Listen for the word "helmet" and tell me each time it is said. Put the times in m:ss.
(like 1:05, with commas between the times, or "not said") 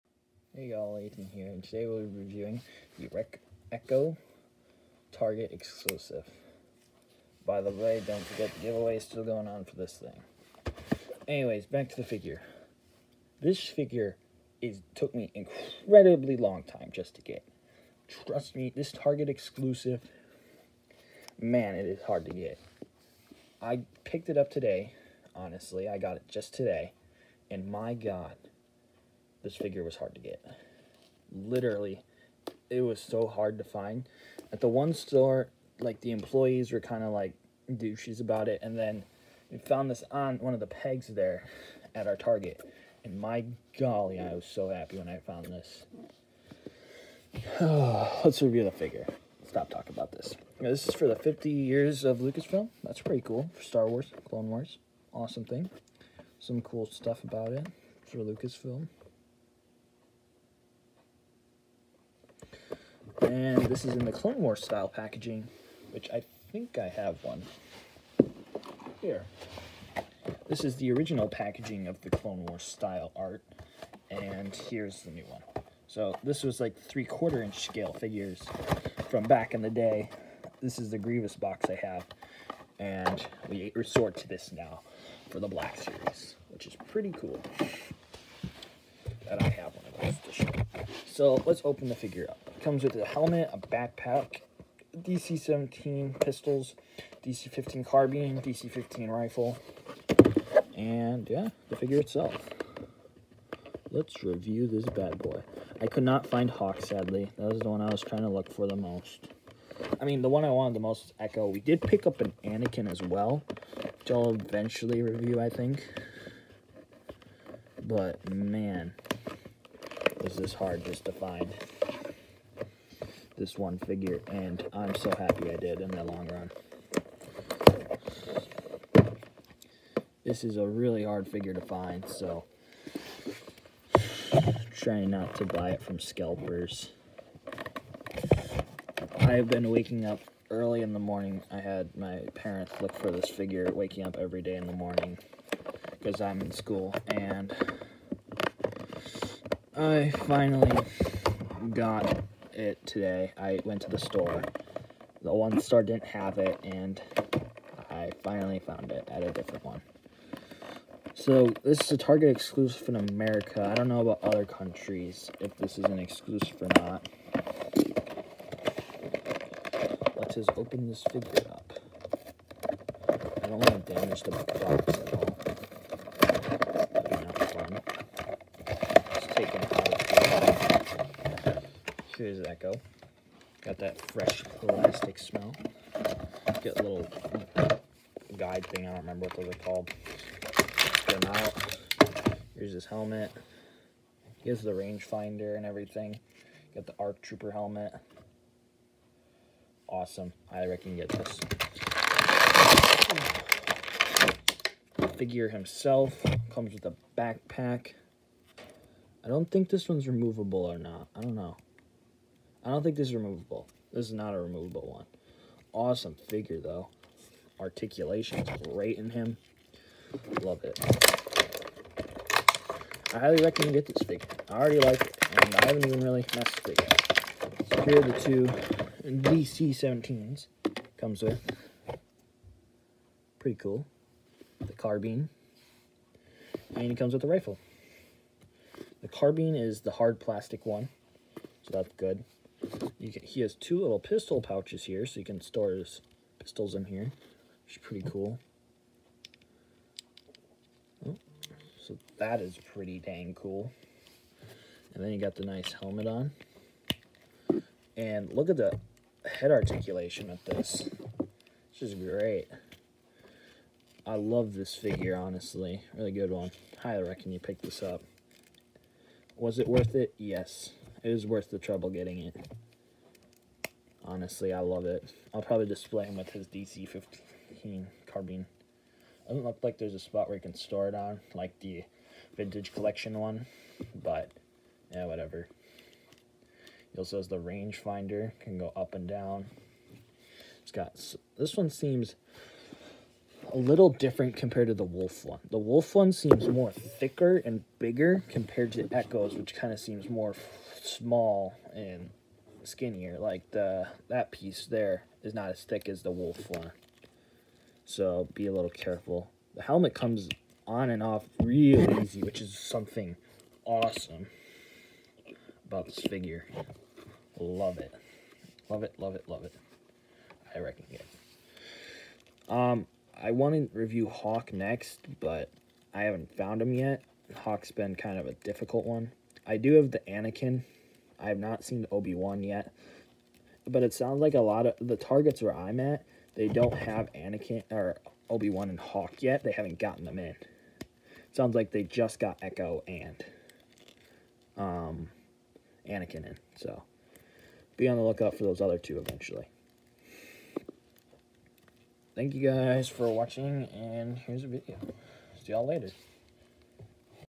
1:33, 3:12, 3:17, 4:15, 5:09.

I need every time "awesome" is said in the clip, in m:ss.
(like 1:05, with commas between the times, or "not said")
0:55, 3:19, 3:35, 5:13.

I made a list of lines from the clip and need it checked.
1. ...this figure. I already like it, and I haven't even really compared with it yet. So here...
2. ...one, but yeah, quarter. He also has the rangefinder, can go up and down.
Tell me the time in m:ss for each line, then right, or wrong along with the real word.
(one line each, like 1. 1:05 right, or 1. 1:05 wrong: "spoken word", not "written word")
1. 3:43 wrong: "messed", not "compared"
2. 4:43 wrong: "whatever", not "quarter".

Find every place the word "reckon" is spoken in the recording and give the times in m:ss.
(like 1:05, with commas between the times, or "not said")
3:20, 4:27, 5:20.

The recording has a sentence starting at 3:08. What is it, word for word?
I don't remember what those are called.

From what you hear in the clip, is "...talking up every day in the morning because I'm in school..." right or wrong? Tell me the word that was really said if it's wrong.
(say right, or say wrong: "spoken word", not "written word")
wrong: "waking", not "talking".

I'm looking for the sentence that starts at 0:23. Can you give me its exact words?
I picked it up today, honestly.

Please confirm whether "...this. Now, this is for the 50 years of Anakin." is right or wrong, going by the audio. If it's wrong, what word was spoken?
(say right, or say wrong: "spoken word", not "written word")
wrong: "Lucasfilm", not "Anakin".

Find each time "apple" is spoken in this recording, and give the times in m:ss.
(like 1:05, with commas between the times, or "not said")
not said.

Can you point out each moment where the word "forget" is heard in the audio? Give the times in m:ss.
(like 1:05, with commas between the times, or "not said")
0:08.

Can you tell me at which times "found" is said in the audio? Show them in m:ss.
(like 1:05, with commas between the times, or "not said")
0:39, 0:45, 2:38, 5:26.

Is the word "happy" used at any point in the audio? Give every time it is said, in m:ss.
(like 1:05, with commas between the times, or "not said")
0:44, 2:05.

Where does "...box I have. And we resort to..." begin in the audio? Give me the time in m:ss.
1:21.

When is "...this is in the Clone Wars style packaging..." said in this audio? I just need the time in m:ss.
1:03.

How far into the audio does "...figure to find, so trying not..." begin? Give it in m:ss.
2:11.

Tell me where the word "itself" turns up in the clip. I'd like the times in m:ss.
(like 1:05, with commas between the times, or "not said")
1:41.